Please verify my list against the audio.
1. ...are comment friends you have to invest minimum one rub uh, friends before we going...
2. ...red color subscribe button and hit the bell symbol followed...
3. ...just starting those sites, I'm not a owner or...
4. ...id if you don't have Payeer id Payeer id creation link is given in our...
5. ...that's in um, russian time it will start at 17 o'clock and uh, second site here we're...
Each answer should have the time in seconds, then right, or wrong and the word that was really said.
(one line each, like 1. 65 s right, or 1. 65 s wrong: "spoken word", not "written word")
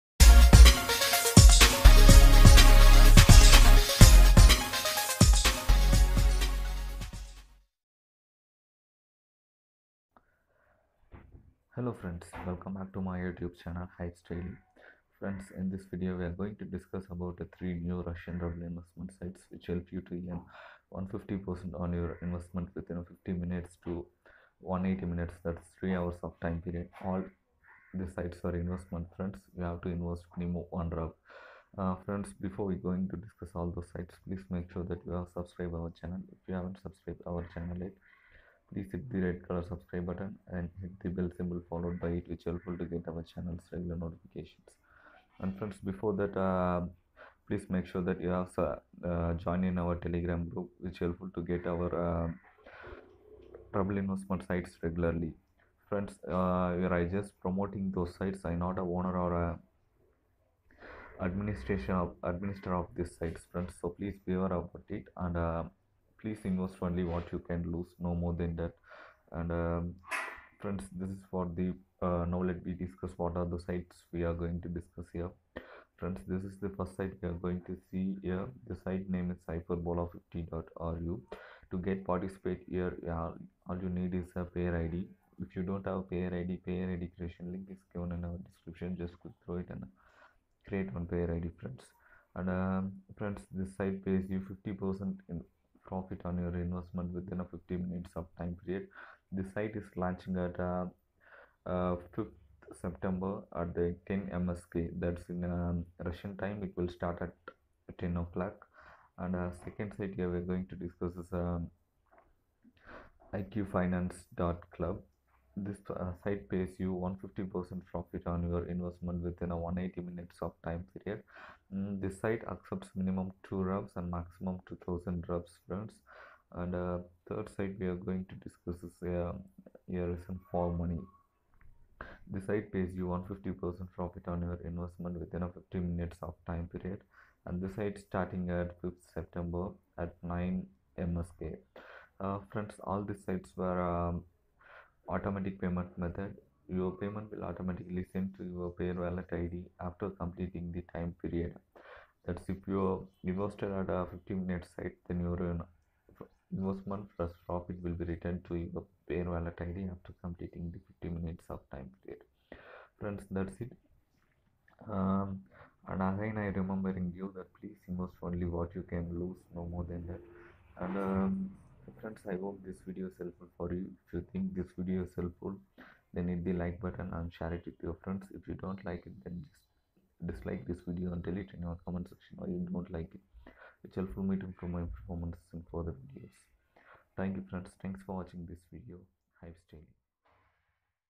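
1. 28 s wrong: "investment", not "comment"
2. 39 s right
3. 57 s wrong: "promoting", not "starting"
4. 84 s right
5. 105 s wrong: "10", not "17".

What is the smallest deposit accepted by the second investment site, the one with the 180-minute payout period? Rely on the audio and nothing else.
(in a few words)
2 rubs.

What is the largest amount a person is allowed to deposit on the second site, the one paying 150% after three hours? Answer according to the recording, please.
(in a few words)
2000 rubs.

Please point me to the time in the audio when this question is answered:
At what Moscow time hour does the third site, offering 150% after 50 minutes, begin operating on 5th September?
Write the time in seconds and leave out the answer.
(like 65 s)
140 s.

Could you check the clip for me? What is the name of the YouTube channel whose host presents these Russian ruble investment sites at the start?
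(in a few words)
Hyips Daily.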